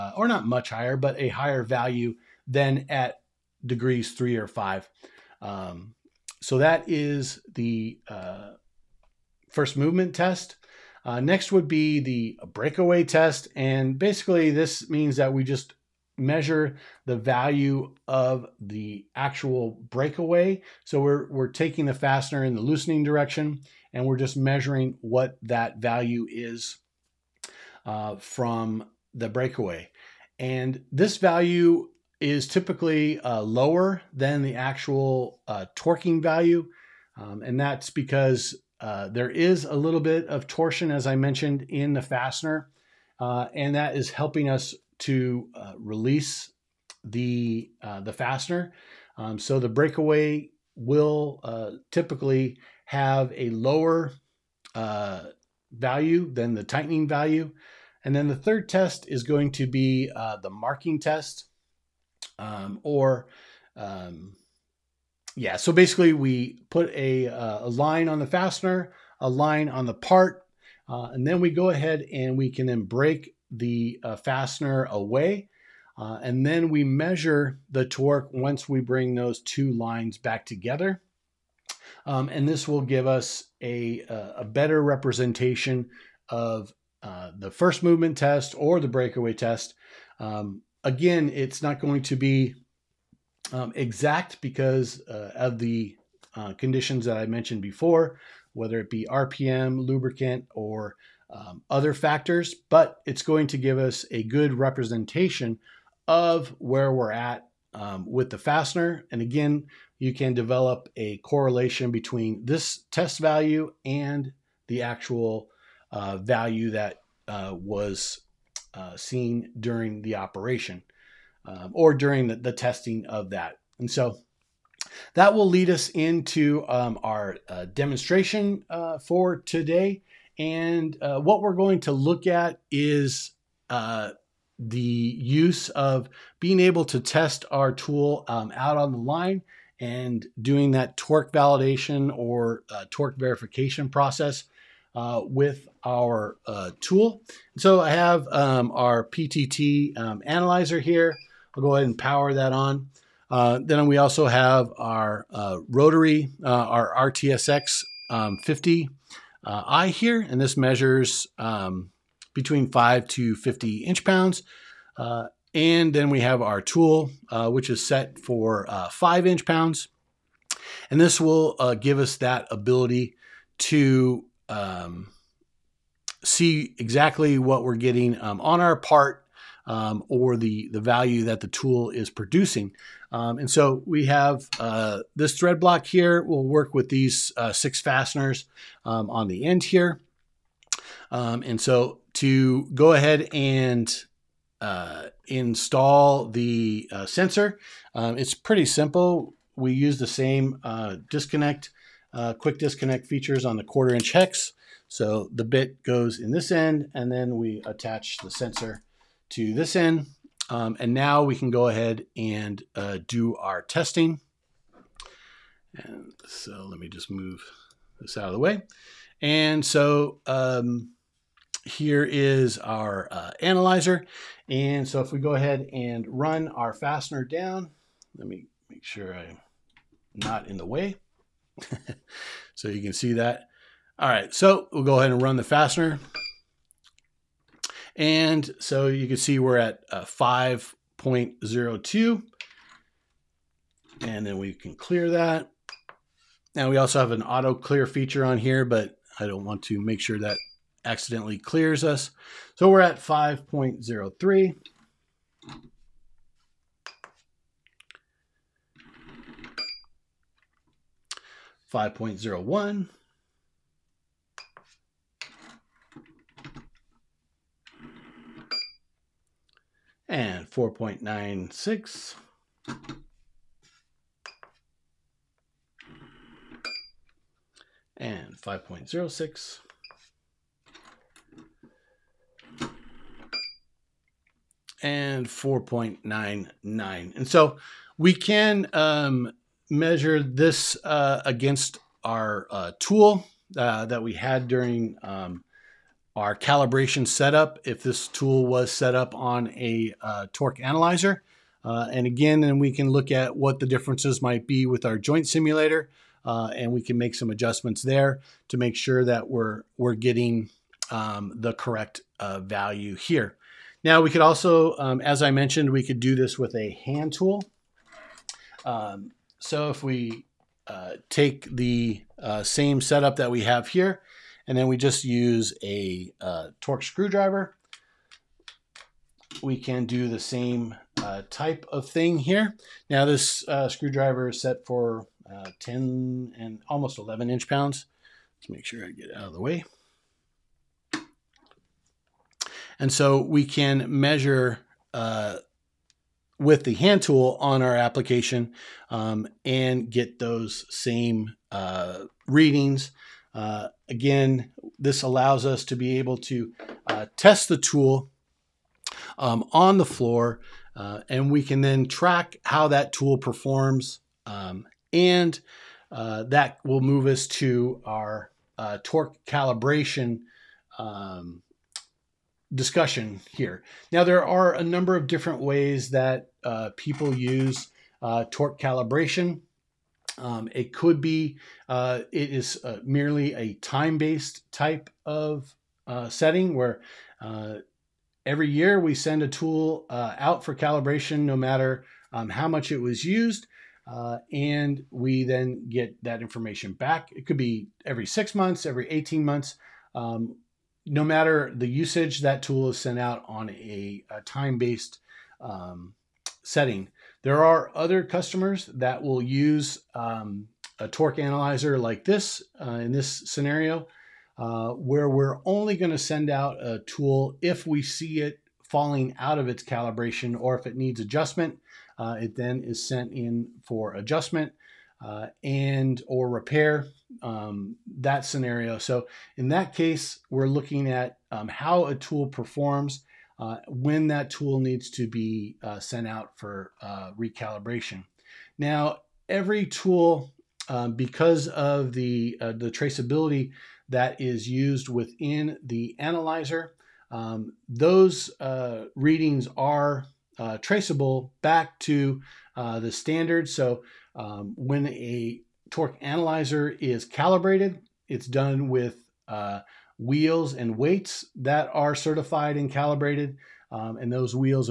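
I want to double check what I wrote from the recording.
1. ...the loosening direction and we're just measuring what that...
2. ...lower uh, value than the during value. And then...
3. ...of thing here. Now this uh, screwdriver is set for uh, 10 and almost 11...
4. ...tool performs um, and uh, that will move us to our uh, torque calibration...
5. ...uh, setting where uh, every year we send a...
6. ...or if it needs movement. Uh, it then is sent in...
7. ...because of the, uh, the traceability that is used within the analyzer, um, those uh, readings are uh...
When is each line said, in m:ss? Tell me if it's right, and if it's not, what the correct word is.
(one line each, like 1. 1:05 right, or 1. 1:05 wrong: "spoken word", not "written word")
1. 0:22 right
2. 0:53 wrong: "tightening", not "during"
3. 5:31 right
4. 6:02 right
5. 6:25 right
6. 7:00 wrong: "adjustment", not "movement"
7. 7:20 right.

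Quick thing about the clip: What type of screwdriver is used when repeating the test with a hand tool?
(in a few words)
Torx screwdriver.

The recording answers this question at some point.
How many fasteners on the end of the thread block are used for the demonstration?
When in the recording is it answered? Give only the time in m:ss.
3:07.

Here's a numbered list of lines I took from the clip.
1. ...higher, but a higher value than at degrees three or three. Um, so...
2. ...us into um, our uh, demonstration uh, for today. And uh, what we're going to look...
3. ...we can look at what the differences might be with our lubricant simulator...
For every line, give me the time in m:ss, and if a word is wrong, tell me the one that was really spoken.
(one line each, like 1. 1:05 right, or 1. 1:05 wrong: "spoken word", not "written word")
1. 0:00 wrong: "five", not "three"
2. 2:05 right
3. 5:02 wrong: "joint", not "lubricant".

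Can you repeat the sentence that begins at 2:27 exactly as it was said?
So I have um, our PTT um, analyzer here.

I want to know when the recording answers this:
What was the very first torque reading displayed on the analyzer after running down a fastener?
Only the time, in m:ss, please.
4:00.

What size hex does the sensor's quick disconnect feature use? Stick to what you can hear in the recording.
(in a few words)
quarter inch.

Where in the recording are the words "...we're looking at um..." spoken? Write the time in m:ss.
7:10.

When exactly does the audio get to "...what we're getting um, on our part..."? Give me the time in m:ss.
2:57.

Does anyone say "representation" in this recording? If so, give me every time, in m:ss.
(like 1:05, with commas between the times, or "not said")
1:24, 1:44.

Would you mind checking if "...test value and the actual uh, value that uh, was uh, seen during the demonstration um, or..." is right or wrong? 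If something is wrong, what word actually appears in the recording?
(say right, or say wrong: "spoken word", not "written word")
wrong: "operation", not "demonstration".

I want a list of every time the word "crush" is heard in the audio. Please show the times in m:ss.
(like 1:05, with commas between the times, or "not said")
not said.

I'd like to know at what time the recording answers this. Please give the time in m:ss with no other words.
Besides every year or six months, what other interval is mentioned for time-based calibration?
6:38.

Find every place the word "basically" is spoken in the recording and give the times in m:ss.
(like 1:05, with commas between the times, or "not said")
0:13, 1:05.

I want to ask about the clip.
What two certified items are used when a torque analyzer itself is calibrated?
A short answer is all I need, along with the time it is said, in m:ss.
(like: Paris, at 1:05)
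wheels and weights, at 7:40.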